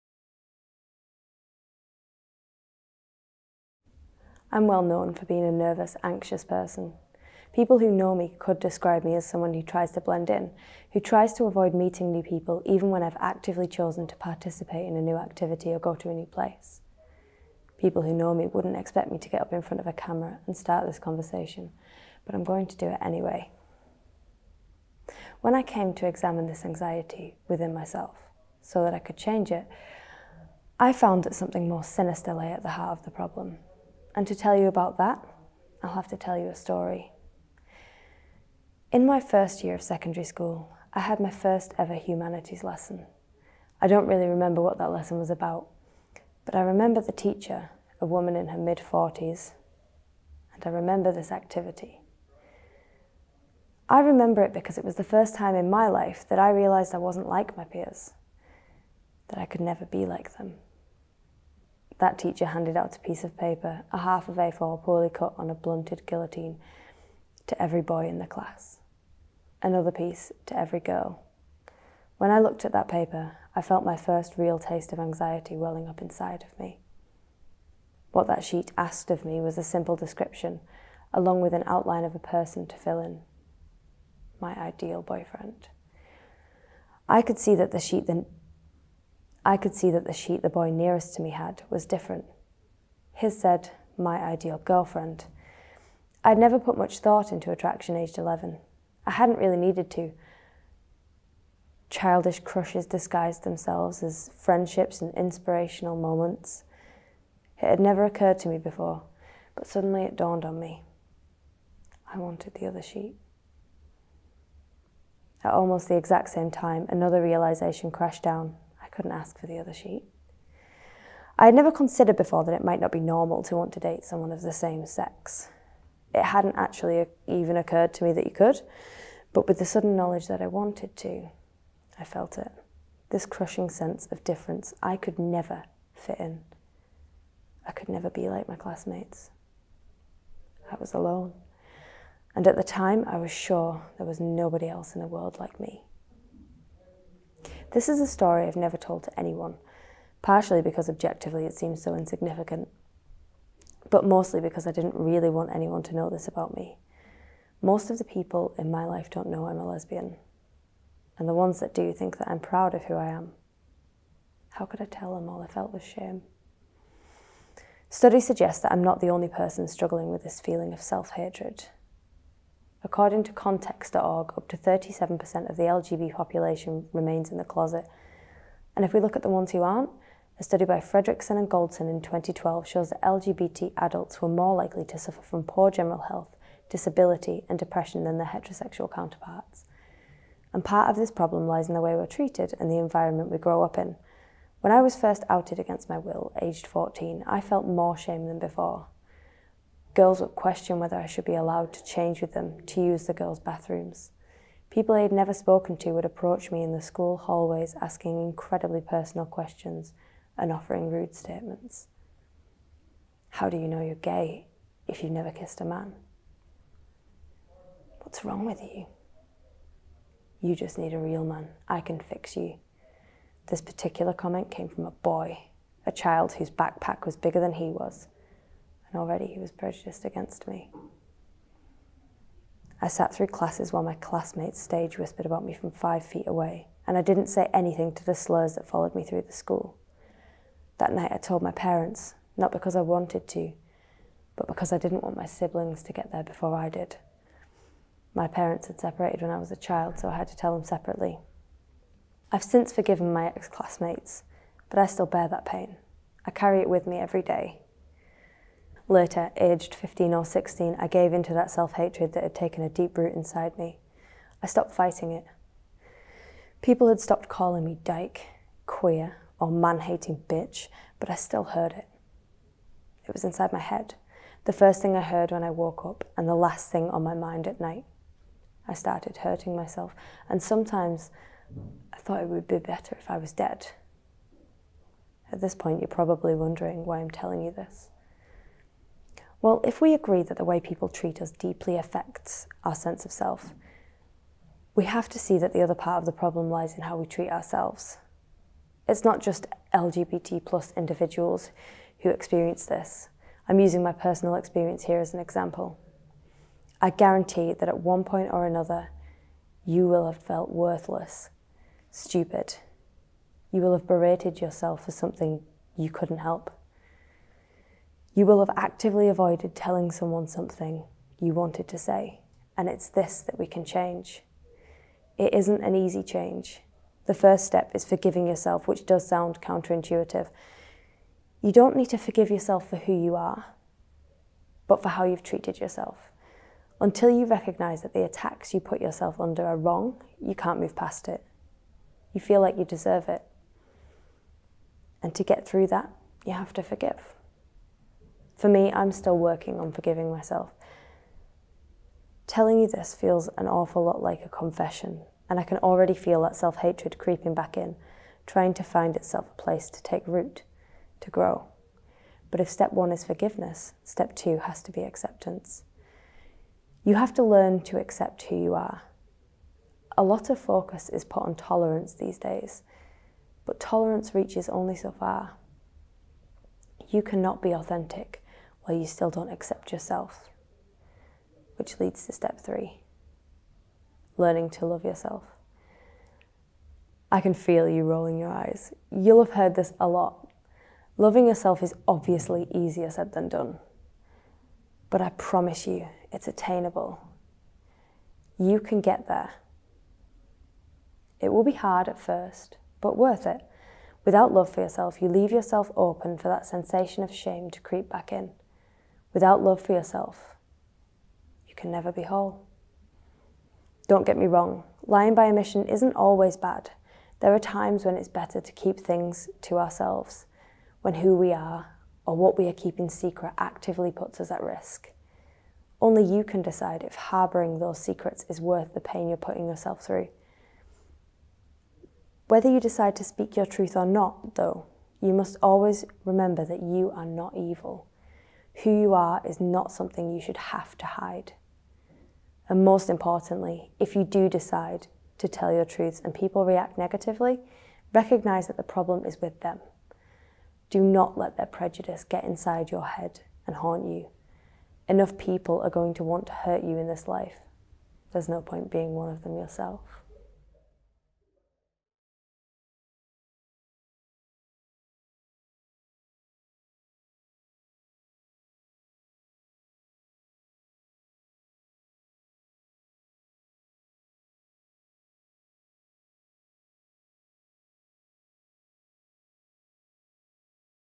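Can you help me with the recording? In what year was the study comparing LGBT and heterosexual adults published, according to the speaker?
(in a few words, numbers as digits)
2012.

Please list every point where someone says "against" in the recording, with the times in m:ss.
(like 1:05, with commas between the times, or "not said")
3:15, 3:50.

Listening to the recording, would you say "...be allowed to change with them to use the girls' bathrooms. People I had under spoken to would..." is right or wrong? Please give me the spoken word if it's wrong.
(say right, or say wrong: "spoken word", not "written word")
wrong: "never", not "under".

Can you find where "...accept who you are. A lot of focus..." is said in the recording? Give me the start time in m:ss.
6:07.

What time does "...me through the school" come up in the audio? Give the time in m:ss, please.
3:58.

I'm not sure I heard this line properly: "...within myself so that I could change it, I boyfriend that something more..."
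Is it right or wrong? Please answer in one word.
wrong.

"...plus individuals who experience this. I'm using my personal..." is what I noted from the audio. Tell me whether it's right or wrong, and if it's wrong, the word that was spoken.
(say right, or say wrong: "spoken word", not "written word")
right.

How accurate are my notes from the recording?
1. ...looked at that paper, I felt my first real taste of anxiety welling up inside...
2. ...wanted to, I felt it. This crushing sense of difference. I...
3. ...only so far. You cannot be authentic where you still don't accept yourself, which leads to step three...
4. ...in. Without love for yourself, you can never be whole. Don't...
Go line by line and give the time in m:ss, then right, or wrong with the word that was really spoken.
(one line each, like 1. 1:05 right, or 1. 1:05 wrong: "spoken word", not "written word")
1. 1:12 right
2. 2:10 right
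3. 6:14 right
4. 6:48 right.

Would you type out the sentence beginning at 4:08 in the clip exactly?
My parents had separated when I was a child, so I had to tell them separately.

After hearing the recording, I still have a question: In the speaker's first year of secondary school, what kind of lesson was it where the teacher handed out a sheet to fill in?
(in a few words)
humanities.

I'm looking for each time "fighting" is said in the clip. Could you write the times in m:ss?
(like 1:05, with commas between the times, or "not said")
4:24.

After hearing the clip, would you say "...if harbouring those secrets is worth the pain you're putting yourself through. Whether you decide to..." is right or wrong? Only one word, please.
right.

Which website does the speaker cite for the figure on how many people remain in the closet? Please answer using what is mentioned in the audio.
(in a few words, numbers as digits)
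context.org.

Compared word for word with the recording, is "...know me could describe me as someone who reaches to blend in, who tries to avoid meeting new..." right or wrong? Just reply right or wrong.
wrong.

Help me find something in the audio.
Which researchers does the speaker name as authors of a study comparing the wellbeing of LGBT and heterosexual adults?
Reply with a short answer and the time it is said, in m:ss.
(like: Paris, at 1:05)
Fredriksen and Goldsen, at 3:00.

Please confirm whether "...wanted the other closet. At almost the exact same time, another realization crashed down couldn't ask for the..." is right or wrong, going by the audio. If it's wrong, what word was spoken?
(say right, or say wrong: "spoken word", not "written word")
wrong: "sheet", not "closet".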